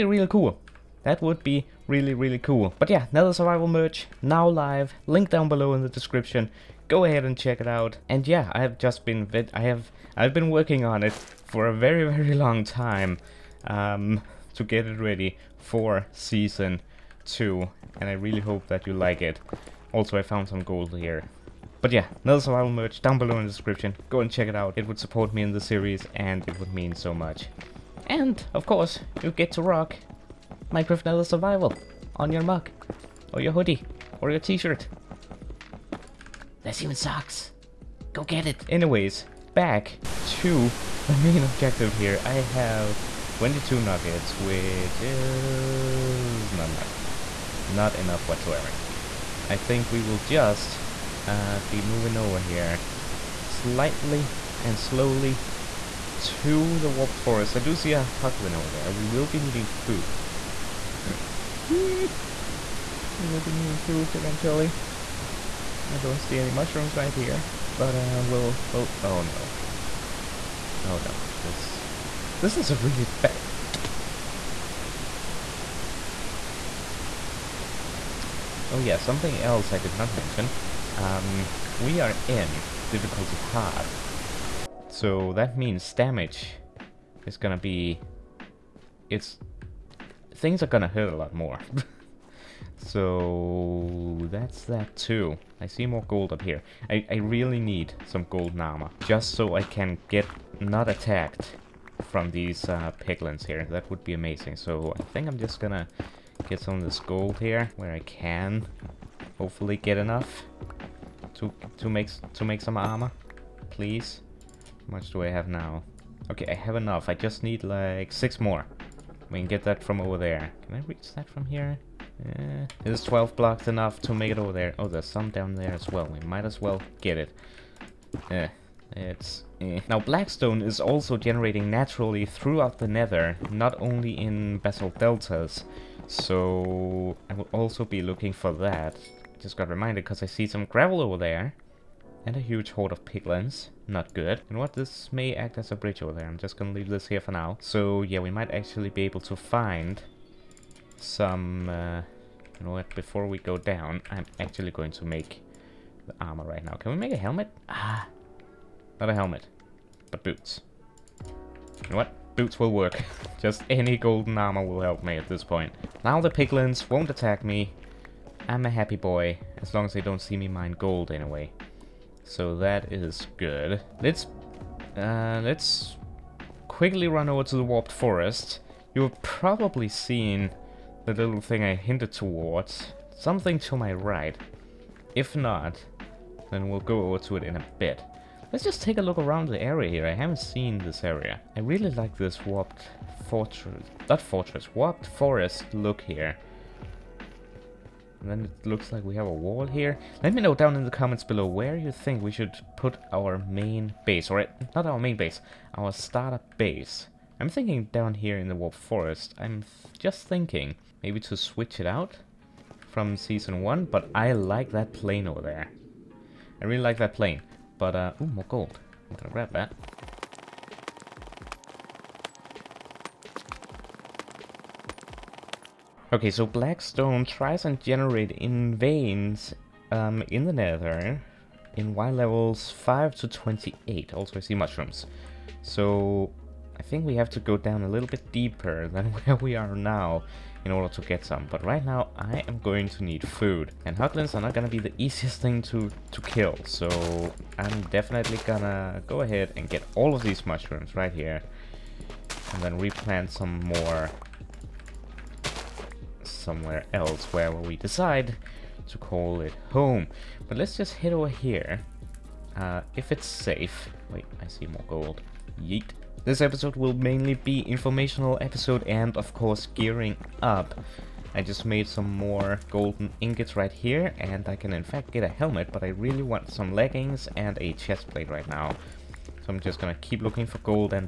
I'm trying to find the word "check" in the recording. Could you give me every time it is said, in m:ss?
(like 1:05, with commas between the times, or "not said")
0:07, 0:24.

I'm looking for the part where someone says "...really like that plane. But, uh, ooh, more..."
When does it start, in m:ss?
3:36.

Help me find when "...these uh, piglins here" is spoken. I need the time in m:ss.
1:42.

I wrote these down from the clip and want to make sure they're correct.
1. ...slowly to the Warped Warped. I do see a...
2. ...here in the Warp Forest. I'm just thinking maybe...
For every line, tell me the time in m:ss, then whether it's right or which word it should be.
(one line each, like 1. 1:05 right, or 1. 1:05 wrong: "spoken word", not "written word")
1. 0:54 wrong: "Forest", not "Warped"
2. 3:28 right.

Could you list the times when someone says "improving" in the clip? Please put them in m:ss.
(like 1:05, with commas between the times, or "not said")
not said.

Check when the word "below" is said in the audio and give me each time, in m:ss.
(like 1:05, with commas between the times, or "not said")
0:05, 0:23, 3:21.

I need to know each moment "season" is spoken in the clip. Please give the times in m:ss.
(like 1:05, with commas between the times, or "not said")
0:16, 3:33.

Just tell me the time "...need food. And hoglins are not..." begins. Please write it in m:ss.
4:03.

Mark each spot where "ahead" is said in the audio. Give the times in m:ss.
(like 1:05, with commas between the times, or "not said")
0:07, 4:09.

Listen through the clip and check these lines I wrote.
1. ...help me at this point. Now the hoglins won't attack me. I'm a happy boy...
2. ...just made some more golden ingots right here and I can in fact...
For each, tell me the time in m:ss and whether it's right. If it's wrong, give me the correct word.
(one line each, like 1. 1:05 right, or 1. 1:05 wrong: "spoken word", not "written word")
1. 2:44 wrong: "piglins", not "hoglins"
2. 4:31 right.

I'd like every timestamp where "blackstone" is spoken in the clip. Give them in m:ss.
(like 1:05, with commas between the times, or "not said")
2:09, 3:46.